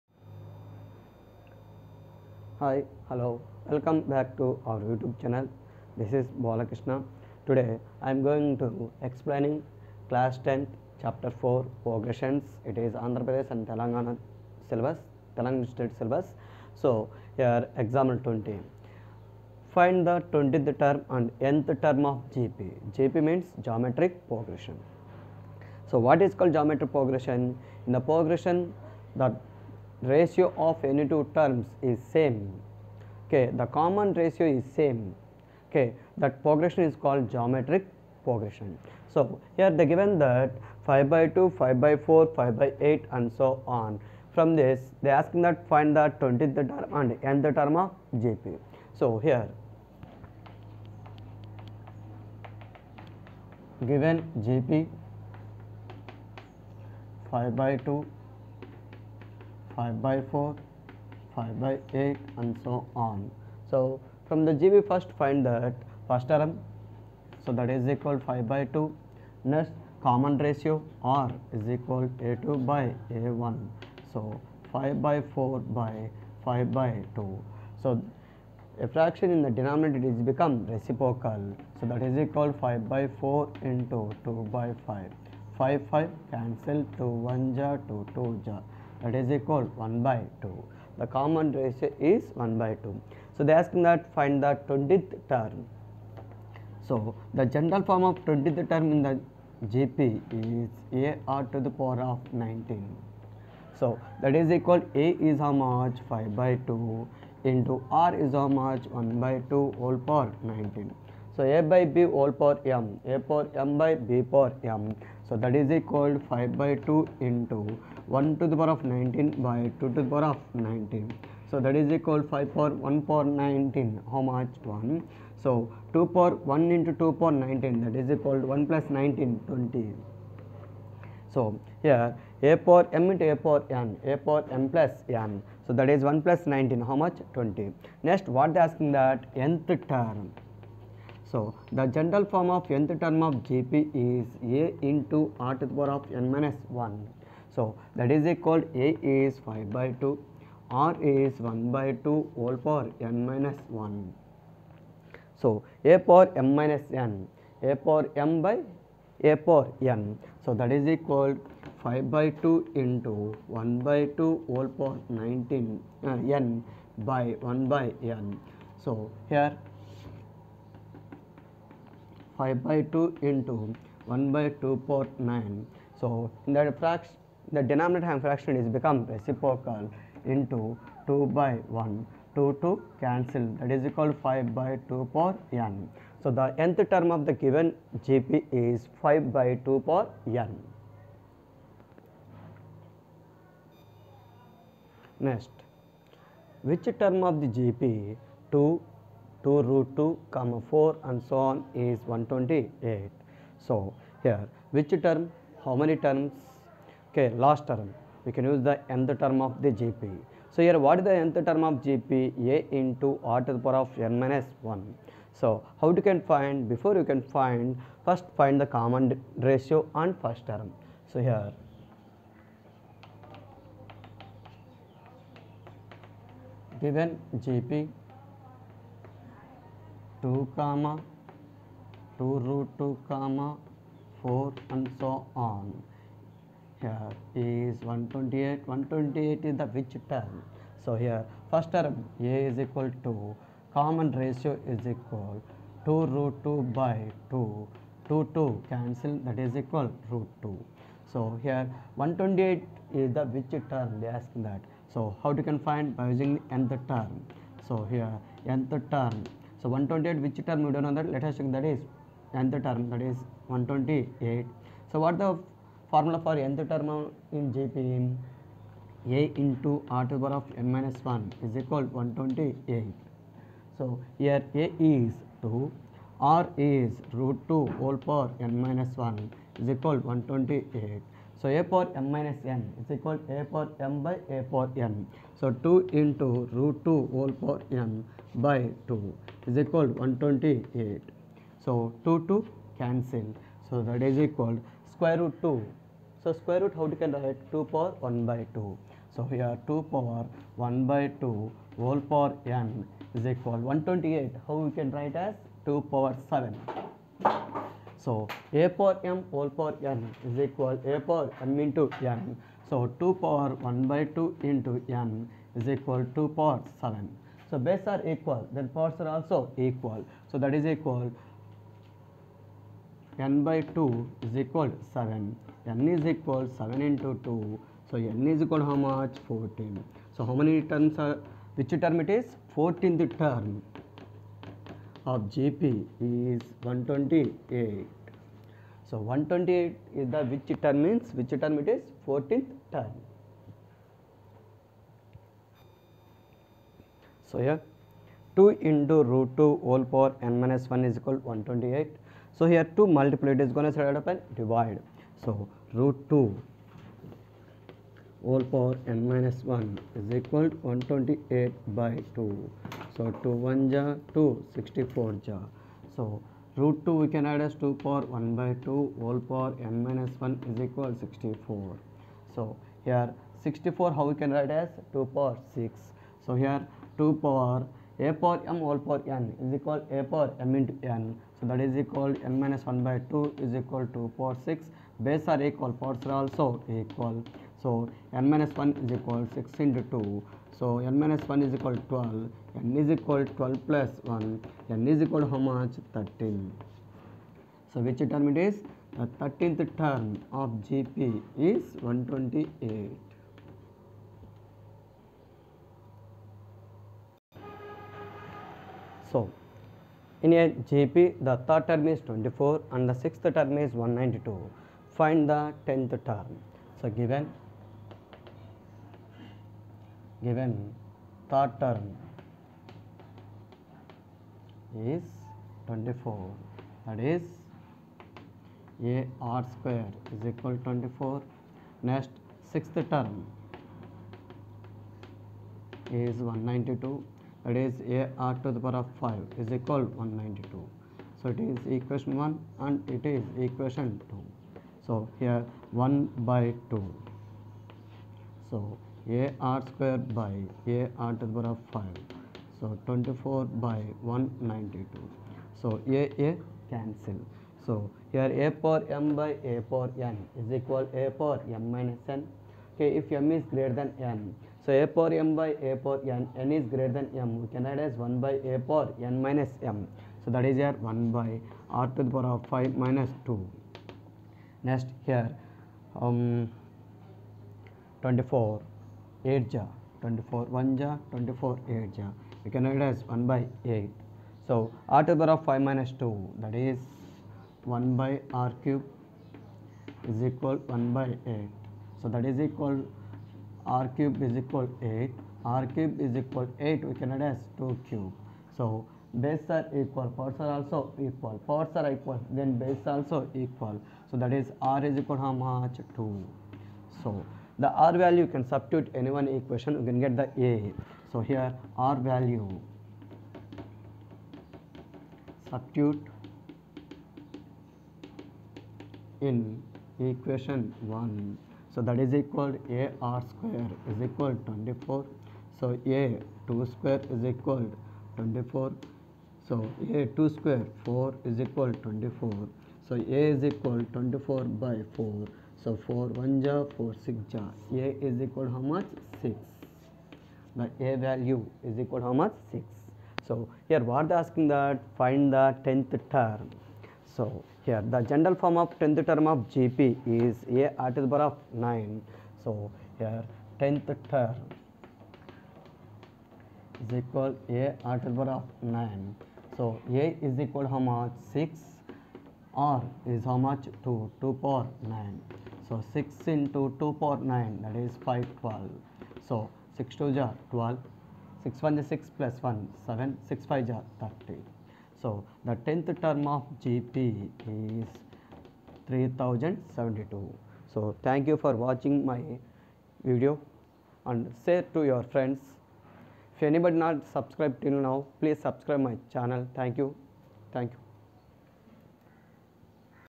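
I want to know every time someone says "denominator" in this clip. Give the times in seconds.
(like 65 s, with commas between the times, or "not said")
79 s, 177 s.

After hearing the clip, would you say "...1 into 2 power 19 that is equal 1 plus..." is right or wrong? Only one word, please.
right.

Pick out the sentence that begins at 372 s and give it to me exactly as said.
So here 64 how we can write as 2 power 6.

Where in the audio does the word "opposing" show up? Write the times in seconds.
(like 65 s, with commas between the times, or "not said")
not said.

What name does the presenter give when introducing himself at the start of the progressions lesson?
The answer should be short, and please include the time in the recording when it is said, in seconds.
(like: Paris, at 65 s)
Balakrishna, at 6 s.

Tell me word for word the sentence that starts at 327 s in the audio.
So n is equal how much?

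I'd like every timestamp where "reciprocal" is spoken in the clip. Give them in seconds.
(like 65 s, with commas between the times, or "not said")
80 s, 179 s.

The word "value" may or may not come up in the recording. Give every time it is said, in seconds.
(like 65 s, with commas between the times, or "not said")
507 s, 512 s, 540 s.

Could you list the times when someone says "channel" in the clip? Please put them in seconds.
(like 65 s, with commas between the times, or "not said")
5 s, 589 s.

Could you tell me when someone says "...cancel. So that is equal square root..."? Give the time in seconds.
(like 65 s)
292 s.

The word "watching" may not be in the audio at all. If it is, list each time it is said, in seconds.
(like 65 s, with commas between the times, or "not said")
581 s.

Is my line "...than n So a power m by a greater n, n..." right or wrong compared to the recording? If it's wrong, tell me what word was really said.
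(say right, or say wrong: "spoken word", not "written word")
wrong: "power", not "greater".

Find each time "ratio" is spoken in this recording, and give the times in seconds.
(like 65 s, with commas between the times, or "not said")
30 s, 34 s, 70 s, 91 s, 219 s, 244 s.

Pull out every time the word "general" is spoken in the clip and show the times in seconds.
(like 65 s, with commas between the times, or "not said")
97 s, 141 s, 548 s.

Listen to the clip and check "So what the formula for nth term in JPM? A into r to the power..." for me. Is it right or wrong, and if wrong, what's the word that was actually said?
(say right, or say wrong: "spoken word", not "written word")
right.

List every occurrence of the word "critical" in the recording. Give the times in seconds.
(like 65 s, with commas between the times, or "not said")
not said.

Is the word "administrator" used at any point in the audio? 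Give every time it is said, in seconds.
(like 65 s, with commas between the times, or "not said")
not said.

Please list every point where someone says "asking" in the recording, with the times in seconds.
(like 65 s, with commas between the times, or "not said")
45 s, 138 s, 544 s.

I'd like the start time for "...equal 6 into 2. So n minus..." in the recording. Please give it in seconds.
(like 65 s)
388 s.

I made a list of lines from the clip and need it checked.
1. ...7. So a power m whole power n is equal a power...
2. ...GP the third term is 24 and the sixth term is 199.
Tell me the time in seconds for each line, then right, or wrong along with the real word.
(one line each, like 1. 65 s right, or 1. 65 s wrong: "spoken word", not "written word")
1. 306 s right
2. 410 s wrong: "192", not "199".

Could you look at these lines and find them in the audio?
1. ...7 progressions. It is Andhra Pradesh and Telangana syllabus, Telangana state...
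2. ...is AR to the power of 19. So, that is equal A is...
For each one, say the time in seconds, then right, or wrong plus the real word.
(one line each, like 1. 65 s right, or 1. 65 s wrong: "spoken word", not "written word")
1. 11 s wrong: "4", not "7"
2. 100 s right.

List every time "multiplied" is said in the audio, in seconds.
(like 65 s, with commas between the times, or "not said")
352 s.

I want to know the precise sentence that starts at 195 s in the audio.
Next, which term of the GP 2 2 root 2 comma 4 and so on is 128.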